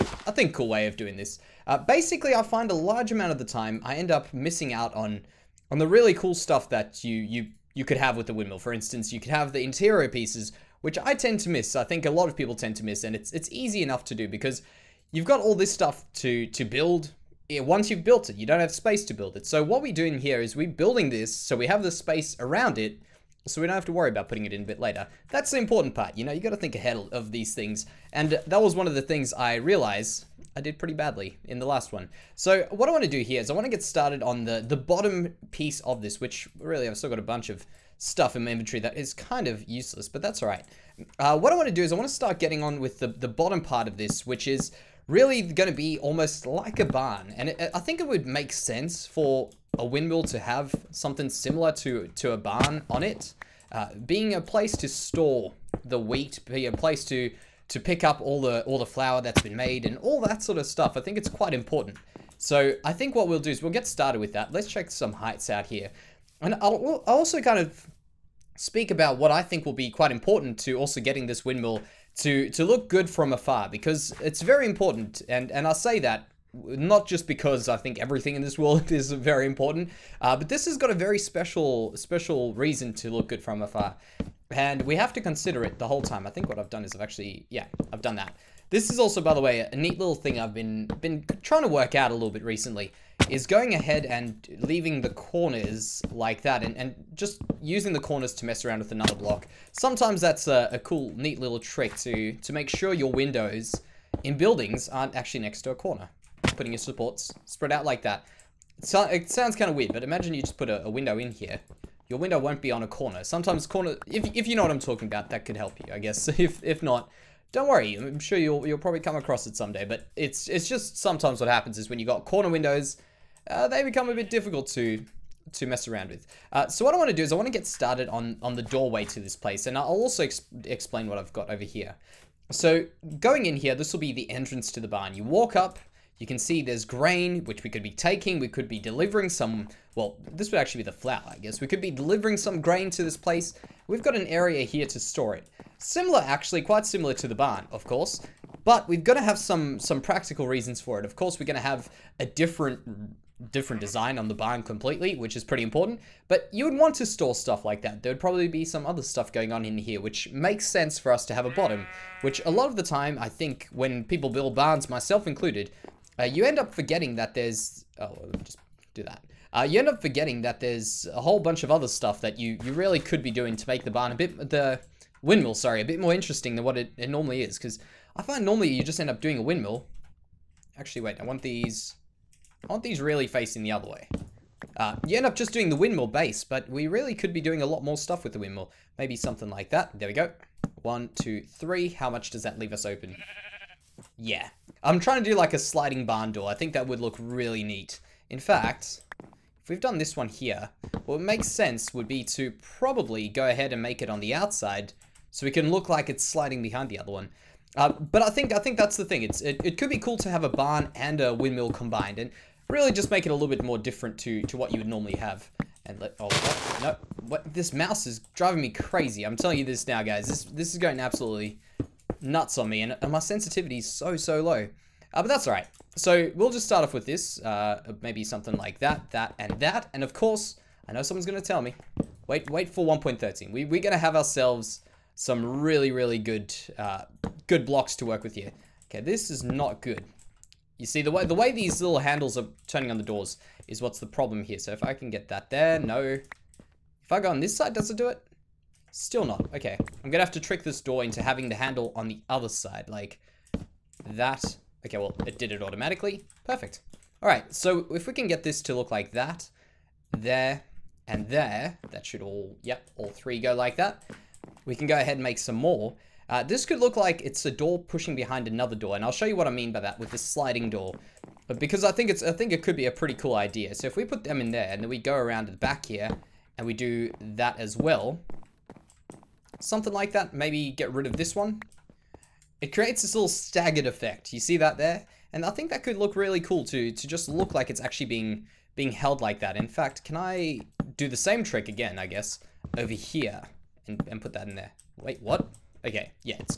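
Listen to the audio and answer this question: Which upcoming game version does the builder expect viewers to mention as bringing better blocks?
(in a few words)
1.13.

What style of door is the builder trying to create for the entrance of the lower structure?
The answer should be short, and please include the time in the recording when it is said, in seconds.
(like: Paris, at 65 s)
Sliding barn door, at 195 s.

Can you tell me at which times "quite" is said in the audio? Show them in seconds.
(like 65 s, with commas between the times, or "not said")
61 s, 69 s, 146 s.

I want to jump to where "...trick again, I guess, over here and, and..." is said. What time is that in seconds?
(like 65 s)
291 s.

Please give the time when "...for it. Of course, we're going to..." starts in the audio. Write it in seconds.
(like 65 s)
150 s.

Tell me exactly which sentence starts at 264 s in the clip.
We can go ahead and make some more.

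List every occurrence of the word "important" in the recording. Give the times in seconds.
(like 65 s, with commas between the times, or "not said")
25 s, 61 s, 70 s, 74 s, 79 s, 155 s.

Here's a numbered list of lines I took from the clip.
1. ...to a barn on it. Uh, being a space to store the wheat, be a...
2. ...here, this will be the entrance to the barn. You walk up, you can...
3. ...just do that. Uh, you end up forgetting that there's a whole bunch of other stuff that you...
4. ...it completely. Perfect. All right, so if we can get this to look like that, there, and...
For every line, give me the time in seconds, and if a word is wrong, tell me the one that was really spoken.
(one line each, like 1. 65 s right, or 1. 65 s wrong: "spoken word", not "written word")
1. 52 s wrong: "place", not "space"
2. 133 s right
3. 168 s right
4. 255 s wrong: "automatically", not "completely".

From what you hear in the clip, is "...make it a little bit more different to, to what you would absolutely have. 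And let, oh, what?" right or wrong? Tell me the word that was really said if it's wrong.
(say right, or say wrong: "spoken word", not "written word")
wrong: "normally", not "absolutely".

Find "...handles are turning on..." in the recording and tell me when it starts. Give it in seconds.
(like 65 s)
241 s.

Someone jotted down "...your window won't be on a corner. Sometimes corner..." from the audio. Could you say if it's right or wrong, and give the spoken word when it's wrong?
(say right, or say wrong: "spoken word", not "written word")
right.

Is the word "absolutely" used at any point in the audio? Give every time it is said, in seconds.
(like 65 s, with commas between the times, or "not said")
220 s.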